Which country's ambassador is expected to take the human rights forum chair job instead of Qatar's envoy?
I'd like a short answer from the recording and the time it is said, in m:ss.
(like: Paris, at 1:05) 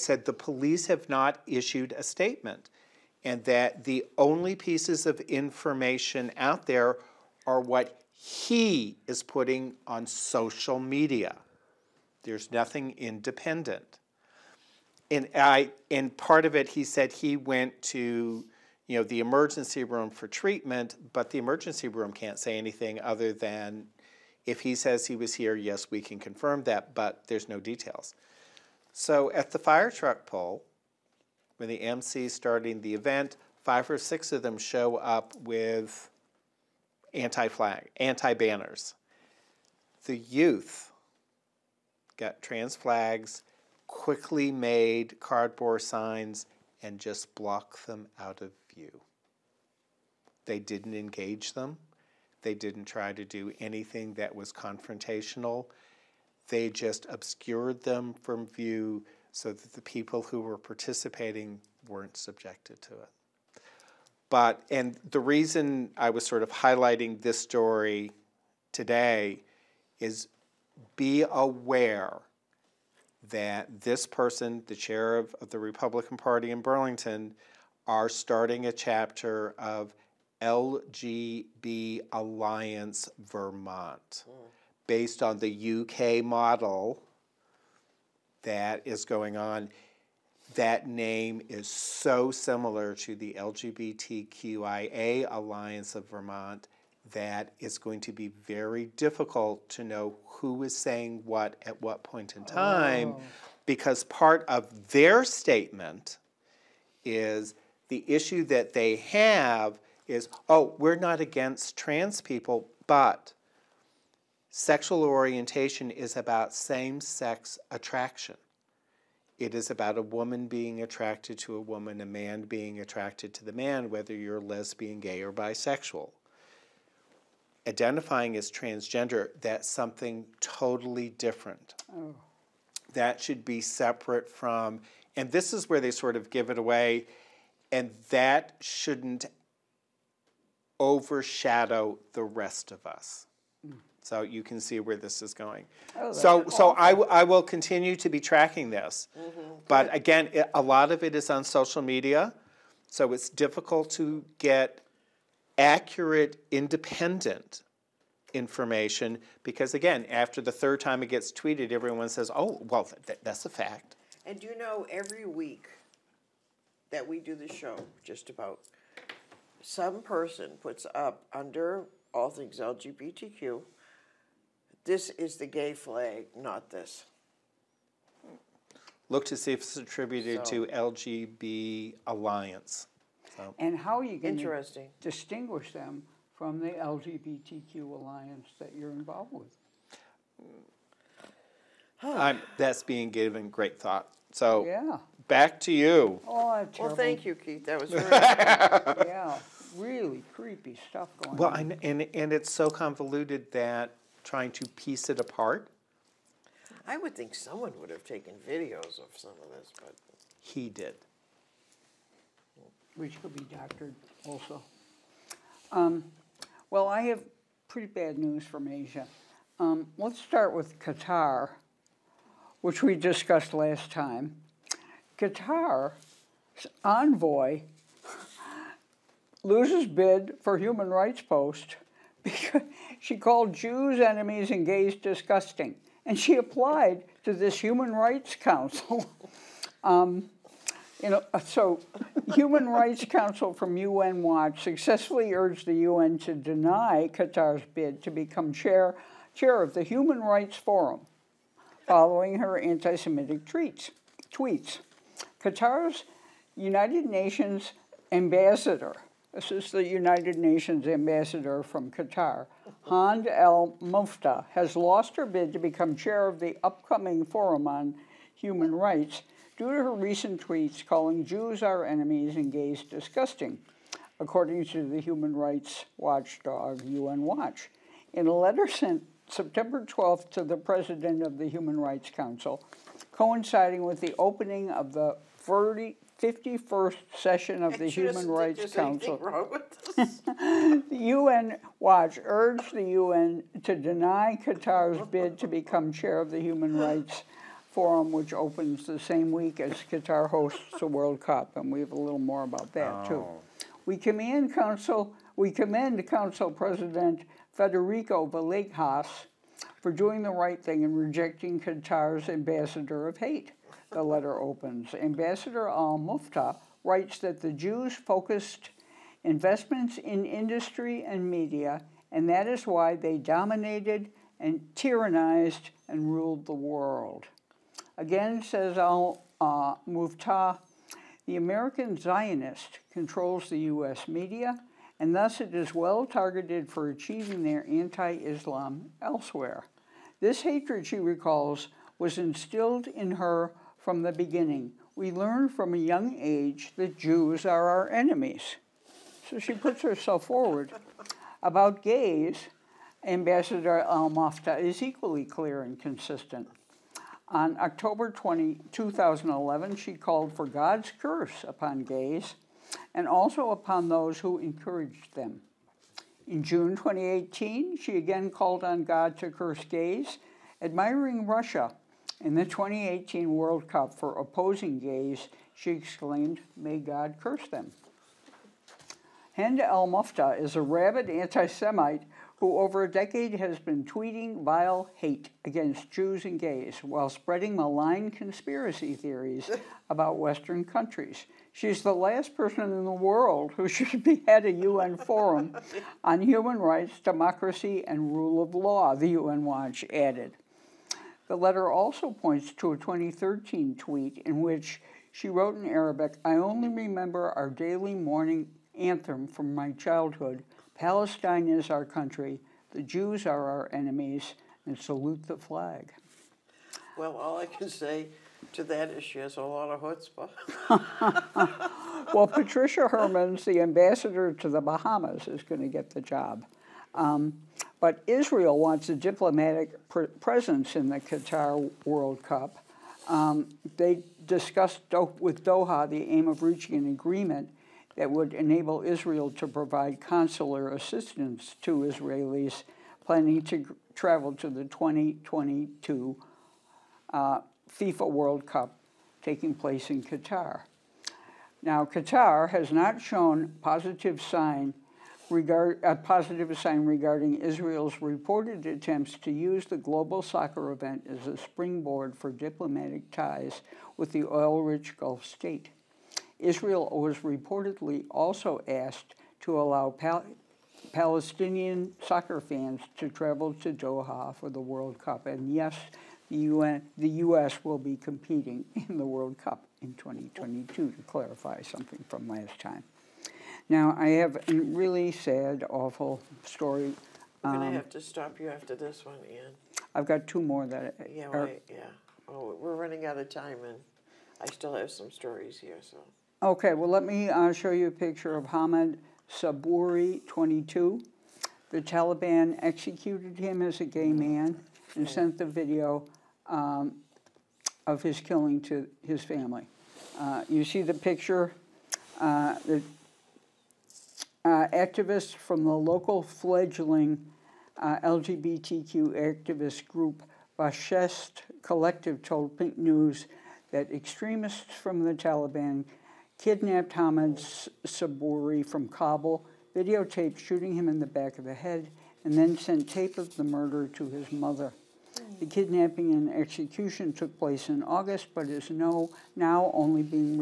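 Bahamas, at 7:04.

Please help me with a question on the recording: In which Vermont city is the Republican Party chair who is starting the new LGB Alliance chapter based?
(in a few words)
Burlington.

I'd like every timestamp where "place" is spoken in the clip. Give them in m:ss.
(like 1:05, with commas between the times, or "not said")
7:29, 8:57.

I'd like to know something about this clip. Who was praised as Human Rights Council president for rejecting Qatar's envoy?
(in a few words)
Federico Villegas.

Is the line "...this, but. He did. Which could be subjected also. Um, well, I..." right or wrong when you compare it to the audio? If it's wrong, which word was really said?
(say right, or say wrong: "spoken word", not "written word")
wrong: "doctored", not "subjected".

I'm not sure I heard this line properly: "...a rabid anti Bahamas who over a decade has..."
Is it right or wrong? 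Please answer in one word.
wrong.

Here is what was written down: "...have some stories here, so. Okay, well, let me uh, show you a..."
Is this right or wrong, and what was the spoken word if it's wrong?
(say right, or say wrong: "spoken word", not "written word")
right.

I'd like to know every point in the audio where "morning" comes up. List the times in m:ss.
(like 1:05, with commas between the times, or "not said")
6:47.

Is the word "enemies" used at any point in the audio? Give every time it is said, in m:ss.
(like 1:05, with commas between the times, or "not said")
3:53, 4:31, 5:47, 6:53.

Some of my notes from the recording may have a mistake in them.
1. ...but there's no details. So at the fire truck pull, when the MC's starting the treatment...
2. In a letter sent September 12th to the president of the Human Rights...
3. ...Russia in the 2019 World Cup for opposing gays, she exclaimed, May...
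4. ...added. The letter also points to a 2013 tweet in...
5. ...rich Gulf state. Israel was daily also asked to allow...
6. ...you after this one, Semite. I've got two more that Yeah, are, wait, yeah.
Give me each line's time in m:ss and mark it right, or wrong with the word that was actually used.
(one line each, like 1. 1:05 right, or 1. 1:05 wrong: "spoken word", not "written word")
1. 0:26 wrong: "event", not "treatment"
2. 4:38 right
3. 6:11 wrong: "2018", not "2019"
4. 6:39 right
5. 7:44 wrong: "reportedly", not "daily"
6. 8:08 wrong: "Ian", not "Semite".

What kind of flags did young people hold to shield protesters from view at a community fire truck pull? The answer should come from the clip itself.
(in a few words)
trans flags.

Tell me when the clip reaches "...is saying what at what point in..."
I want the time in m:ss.
1:40.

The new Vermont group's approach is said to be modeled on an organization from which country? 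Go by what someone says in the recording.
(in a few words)
UK.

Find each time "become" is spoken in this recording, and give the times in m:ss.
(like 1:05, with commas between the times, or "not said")
4:08, 4:25, 4:55.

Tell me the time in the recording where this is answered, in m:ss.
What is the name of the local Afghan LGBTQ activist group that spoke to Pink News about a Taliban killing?
8:40.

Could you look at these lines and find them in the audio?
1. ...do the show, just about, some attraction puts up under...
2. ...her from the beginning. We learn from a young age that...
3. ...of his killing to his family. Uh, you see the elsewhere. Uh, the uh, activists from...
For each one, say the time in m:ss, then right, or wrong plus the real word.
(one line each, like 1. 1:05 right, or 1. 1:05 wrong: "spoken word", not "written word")
1. 2:47 wrong: "person", not "attraction"
2. 5:43 right
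3. 8:27 wrong: "picture", not "elsewhere".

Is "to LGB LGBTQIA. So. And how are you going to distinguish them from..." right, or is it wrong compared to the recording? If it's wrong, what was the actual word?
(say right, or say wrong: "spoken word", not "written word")
wrong: "Alliance", not "LGBTQIA".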